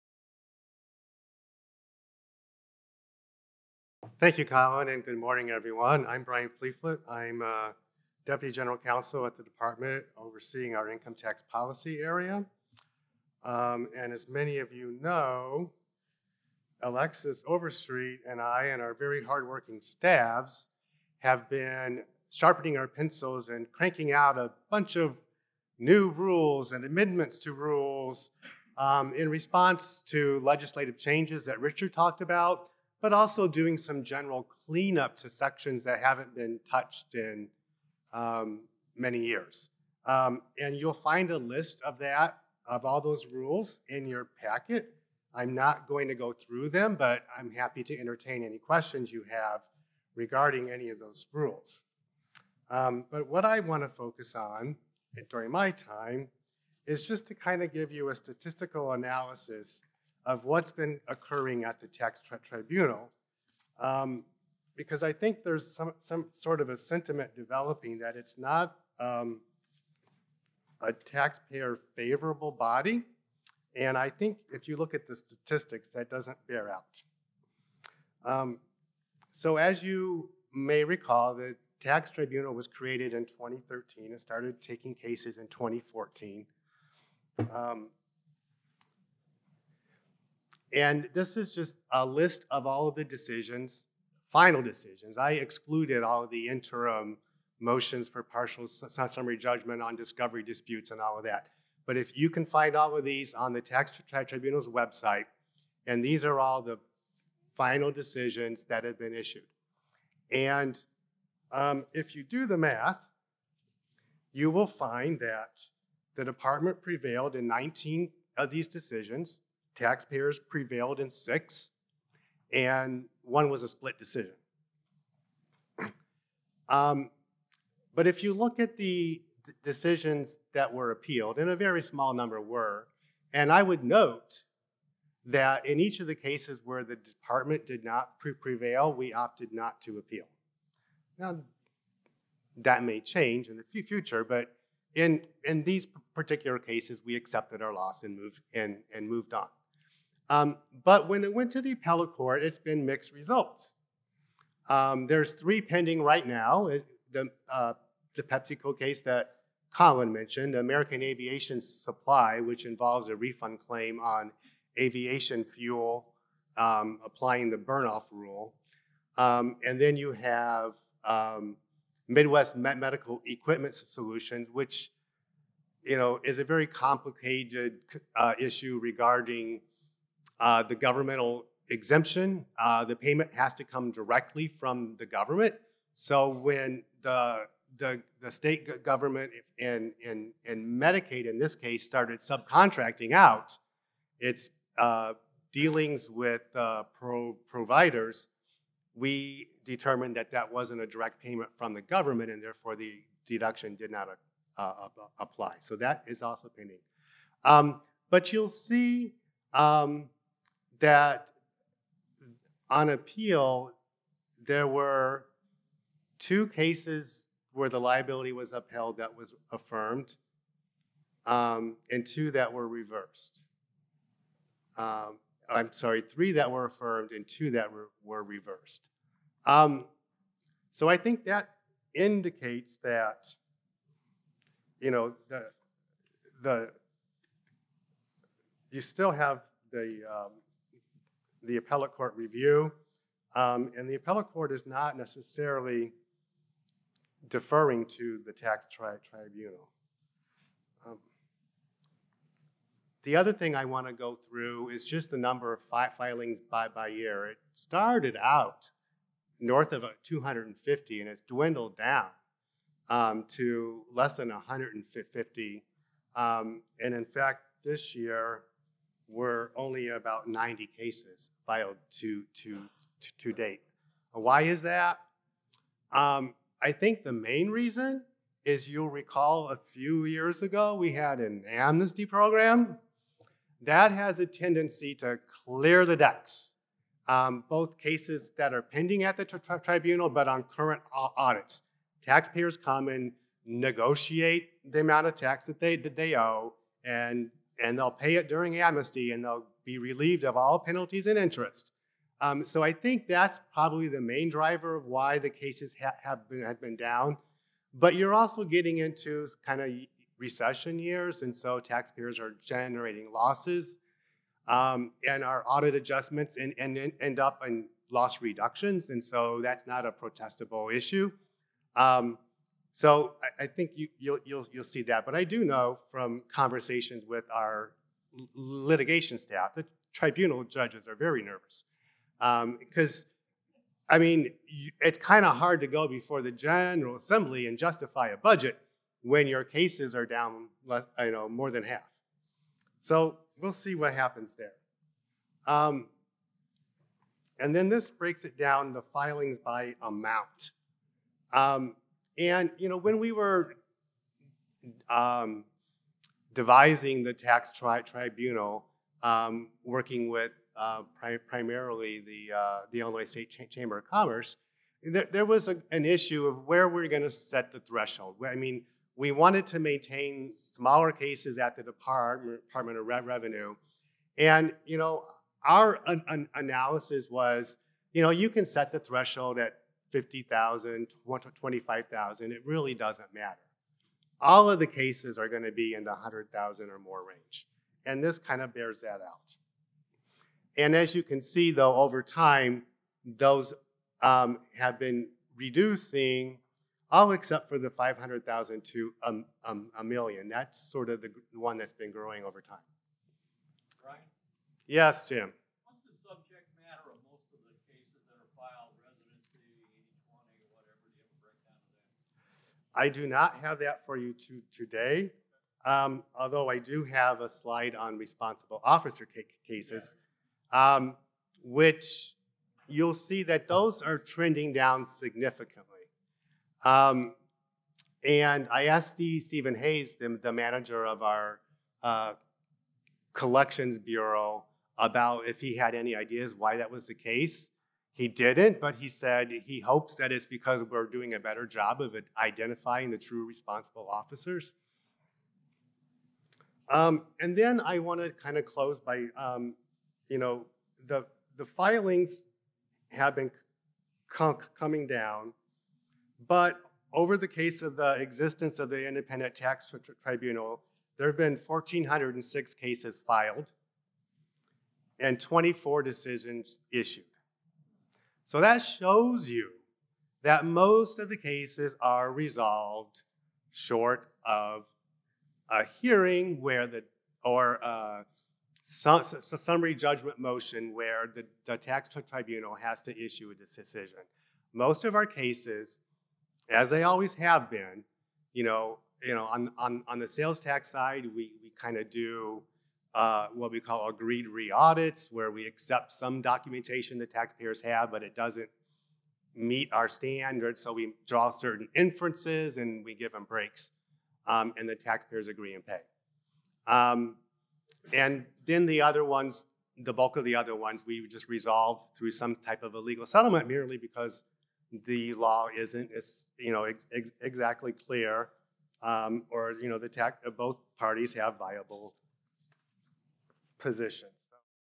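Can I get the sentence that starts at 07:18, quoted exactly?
He didn't, but he said he hopes that it's because we're doing a better job of identifying the true responsible officers.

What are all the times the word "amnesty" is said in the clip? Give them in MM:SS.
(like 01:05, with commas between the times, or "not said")
04:41, 04:58.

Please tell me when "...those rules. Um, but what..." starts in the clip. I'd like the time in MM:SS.
00:50.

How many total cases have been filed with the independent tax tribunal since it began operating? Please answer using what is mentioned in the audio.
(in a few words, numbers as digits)
1,406.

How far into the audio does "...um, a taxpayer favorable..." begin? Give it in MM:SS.
01:08.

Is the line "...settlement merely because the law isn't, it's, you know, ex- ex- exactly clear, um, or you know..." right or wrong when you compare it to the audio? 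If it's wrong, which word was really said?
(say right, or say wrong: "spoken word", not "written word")
right.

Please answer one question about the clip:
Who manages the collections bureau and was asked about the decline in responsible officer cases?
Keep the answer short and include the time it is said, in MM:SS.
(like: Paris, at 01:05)
Stephen Hayes, at 07:09.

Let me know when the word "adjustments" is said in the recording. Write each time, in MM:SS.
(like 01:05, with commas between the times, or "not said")
05:15.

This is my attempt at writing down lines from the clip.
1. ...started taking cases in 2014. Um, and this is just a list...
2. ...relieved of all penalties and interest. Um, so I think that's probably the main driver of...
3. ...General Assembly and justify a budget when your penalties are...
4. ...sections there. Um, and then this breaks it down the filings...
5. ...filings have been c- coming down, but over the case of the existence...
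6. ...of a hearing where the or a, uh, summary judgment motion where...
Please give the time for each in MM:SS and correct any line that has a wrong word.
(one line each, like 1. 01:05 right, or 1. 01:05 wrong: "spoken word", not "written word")
1. 01:24 right
2. 04:59 right
3. 05:36 wrong: "cases", not "penalties"
4. 05:43 wrong: "happens", not "sections"
5. 07:31 right
6. 07:54 right.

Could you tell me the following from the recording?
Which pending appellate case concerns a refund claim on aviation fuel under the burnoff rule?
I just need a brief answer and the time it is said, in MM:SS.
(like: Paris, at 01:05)
American Aviation Supply, at 02:40.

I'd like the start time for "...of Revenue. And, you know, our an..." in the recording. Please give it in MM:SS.
06:12.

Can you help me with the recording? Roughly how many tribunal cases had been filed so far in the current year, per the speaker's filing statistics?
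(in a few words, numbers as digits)
90.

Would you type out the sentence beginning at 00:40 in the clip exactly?
Um, and you'll find a list of that, of all those rules in your packet.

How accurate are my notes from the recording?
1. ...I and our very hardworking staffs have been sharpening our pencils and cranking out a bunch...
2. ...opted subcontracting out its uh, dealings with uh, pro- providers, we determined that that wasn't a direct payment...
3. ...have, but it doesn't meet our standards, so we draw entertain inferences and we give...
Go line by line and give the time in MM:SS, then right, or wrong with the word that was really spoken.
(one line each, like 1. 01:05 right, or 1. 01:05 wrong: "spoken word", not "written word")
1. 00:18 right
2. 03:11 wrong: "started", not "opted"
3. 08:17 wrong: "certain", not "entertain".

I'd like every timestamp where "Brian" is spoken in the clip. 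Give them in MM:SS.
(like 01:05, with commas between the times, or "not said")
00:06.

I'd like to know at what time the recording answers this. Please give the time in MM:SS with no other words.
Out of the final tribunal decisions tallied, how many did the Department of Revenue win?
01:57.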